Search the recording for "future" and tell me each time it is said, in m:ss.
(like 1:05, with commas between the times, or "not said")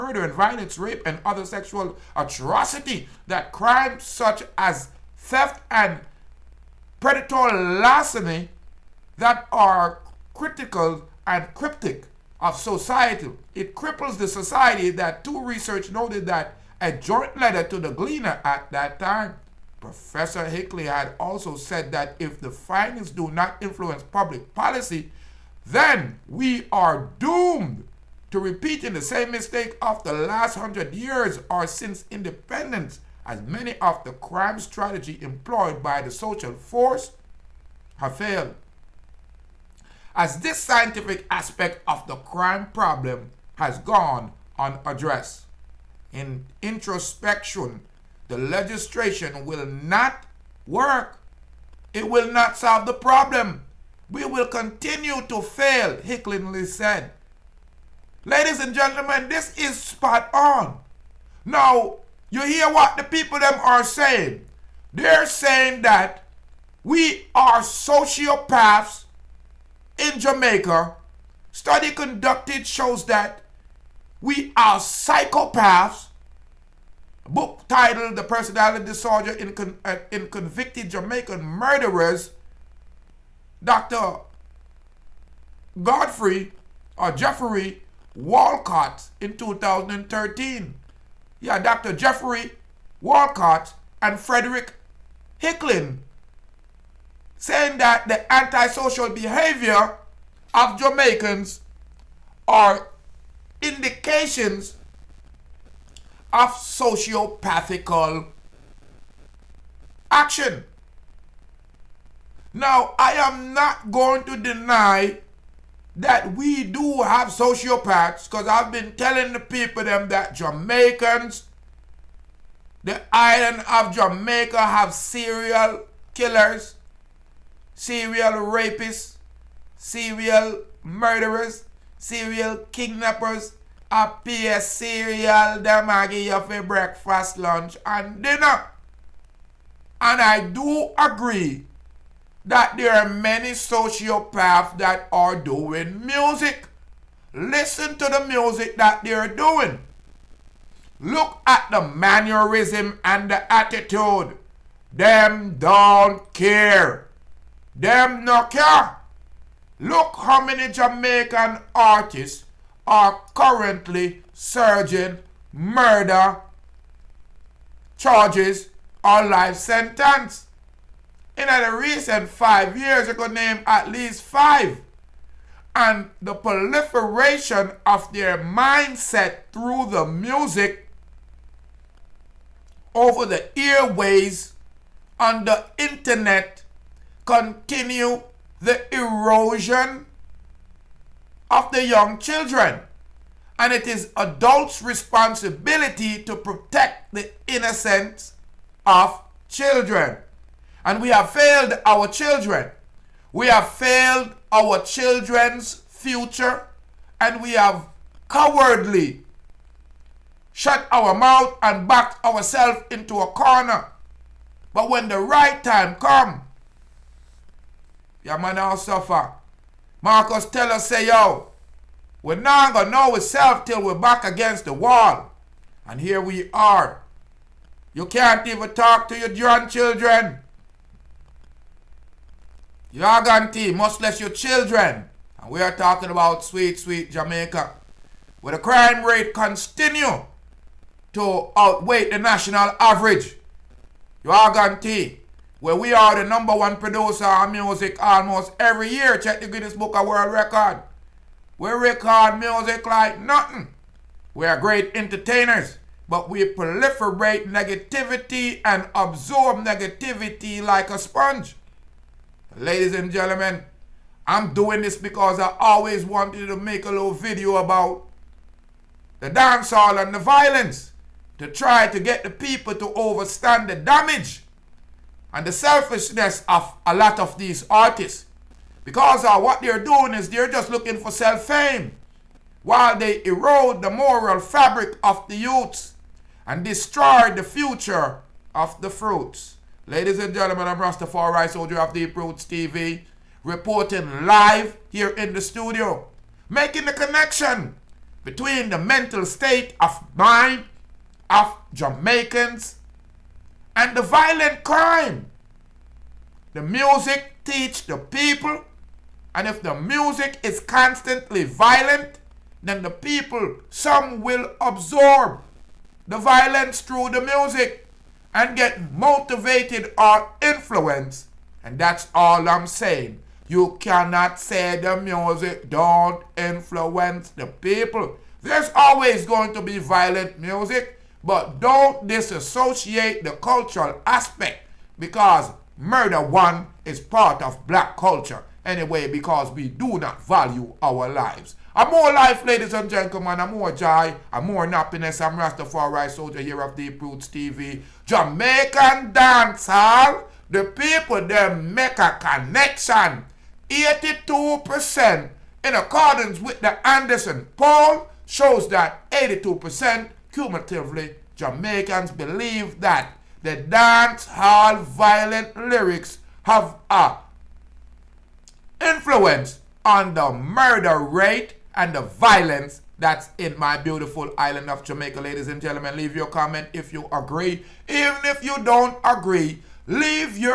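3:25, 4:47.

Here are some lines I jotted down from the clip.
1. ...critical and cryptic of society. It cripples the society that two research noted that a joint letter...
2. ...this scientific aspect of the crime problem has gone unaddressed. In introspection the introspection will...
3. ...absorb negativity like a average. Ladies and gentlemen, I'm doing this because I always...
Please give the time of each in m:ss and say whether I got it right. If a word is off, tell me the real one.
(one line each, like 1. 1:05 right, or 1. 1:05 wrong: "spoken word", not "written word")
1. 0:10 right
2. 0:40 wrong: "legislation", not "introspection"
3. 4:18 wrong: "sponge", not "average".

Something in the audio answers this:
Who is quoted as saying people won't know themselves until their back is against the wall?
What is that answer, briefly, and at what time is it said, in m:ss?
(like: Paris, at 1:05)
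Marcus, at 3:40.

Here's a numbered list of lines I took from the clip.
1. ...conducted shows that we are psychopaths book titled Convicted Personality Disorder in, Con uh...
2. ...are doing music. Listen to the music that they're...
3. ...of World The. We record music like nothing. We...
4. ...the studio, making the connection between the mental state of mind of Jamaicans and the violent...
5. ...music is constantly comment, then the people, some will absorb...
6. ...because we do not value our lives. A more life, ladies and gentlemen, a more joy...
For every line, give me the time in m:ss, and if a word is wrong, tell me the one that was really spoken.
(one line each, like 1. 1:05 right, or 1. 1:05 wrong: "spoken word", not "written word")
1. 1:11 wrong: "The", not "Convicted"
2. 2:25 right
3. 4:09 wrong: "Record", not "The"
4. 4:55 right
5. 5:09 wrong: "violent", not "comment"
6. 5:39 right.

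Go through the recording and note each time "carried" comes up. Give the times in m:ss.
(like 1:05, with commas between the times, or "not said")
not said.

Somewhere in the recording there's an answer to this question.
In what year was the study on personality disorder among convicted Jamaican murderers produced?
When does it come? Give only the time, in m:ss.
1:29.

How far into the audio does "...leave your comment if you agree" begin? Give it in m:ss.
6:15.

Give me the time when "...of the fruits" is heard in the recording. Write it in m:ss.
4:48.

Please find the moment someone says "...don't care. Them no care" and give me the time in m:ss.
2:35.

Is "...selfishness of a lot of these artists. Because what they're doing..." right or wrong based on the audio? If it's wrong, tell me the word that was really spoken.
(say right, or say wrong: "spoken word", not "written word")
right.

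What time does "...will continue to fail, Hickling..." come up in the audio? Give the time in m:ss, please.
0:54.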